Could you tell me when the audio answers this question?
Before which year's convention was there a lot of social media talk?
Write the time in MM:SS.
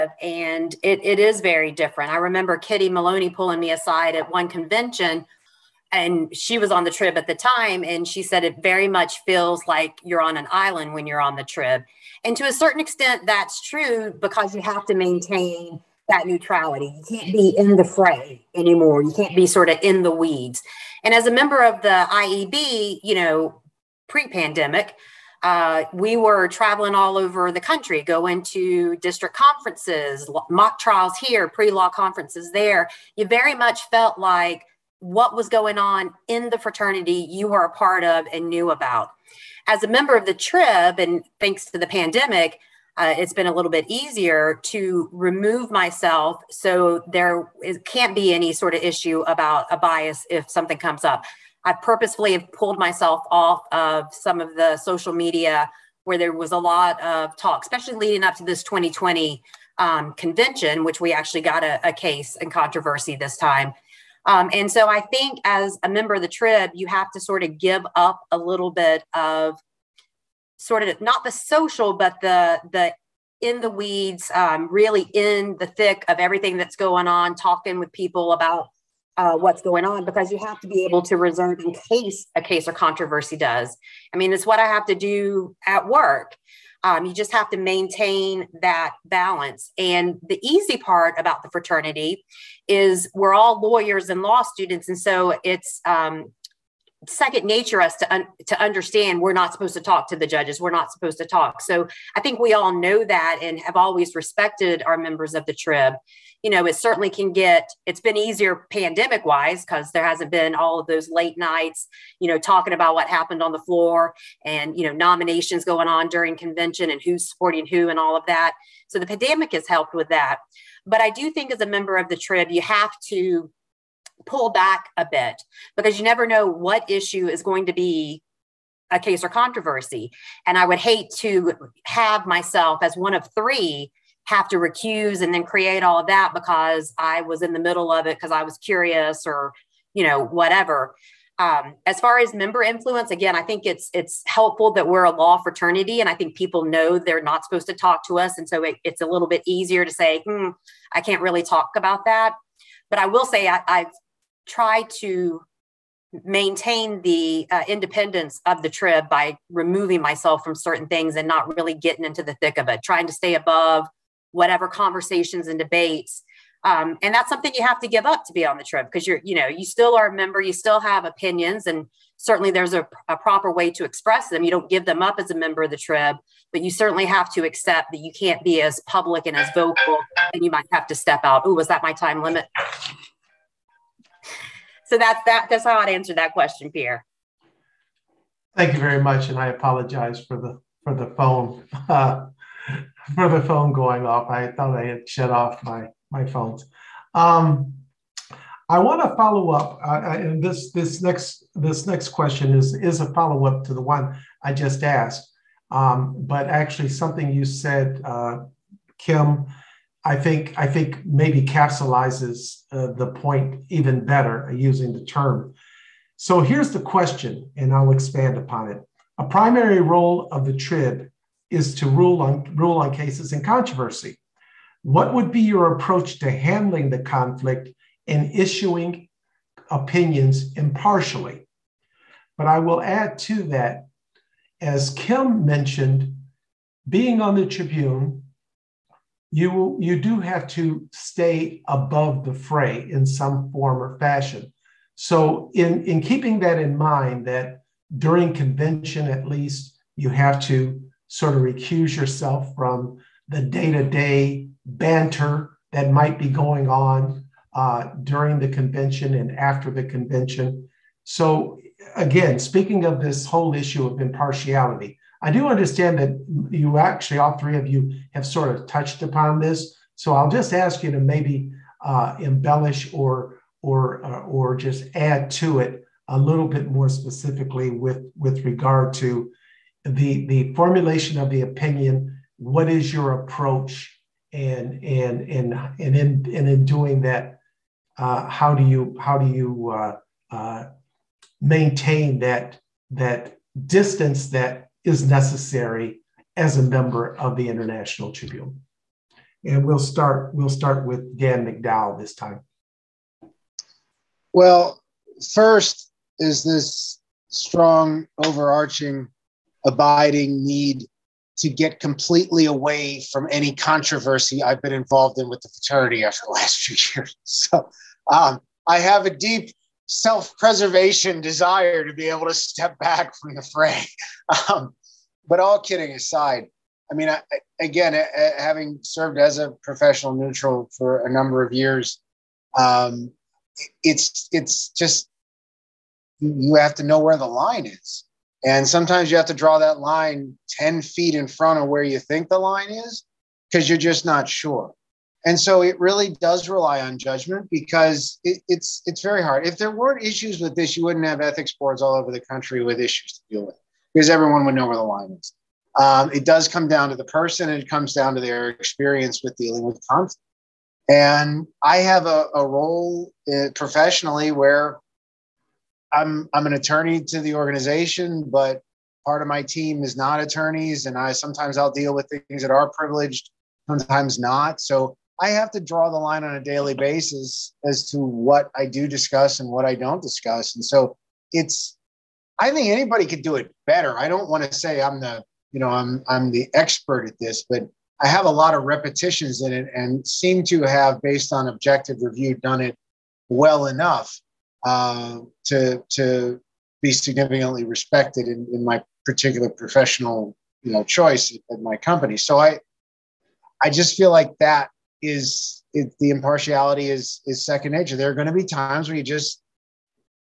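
00:58.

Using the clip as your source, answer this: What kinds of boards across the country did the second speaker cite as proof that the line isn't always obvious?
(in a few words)
ethics boards.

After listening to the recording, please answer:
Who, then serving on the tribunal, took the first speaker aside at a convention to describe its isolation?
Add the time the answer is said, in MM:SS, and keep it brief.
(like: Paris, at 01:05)
Kitty Maloney, at 00:02.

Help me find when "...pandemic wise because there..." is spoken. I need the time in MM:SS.
01:48.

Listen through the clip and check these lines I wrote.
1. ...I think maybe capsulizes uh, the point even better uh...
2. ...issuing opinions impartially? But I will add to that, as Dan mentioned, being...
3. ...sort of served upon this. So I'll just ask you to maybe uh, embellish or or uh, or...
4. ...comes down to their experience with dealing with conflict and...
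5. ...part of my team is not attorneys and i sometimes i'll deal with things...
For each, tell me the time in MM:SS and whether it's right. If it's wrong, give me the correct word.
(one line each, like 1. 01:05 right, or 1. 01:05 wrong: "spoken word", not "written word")
1. 03:30 right
2. 03:48 wrong: "Kim", not "Dan"
3. 04:28 wrong: "touched", not "served"
4. 05:57 right
5. 06:09 right.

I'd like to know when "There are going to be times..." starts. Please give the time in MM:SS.
06:47.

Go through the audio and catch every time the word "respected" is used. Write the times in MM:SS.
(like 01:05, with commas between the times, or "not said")
01:44, 06:37.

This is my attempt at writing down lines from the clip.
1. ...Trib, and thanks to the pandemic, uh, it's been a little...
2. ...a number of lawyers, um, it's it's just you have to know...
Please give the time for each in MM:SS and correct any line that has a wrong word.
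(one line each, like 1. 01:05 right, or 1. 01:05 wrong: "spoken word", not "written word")
1. 00:40 right
2. 05:31 wrong: "years", not "lawyers".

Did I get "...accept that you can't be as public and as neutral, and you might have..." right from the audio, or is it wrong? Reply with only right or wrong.
wrong.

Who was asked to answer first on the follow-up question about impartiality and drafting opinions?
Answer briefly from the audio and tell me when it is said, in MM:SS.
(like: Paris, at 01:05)
Dan McDowell, at 05:01.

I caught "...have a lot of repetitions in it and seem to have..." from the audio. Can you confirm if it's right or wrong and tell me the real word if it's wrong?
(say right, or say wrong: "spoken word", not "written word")
right.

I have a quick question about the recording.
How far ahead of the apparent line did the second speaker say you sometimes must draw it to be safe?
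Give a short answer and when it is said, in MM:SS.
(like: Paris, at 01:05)
10 feet, at 05:40.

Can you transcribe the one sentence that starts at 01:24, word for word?
I mean, it's what I have to do at work.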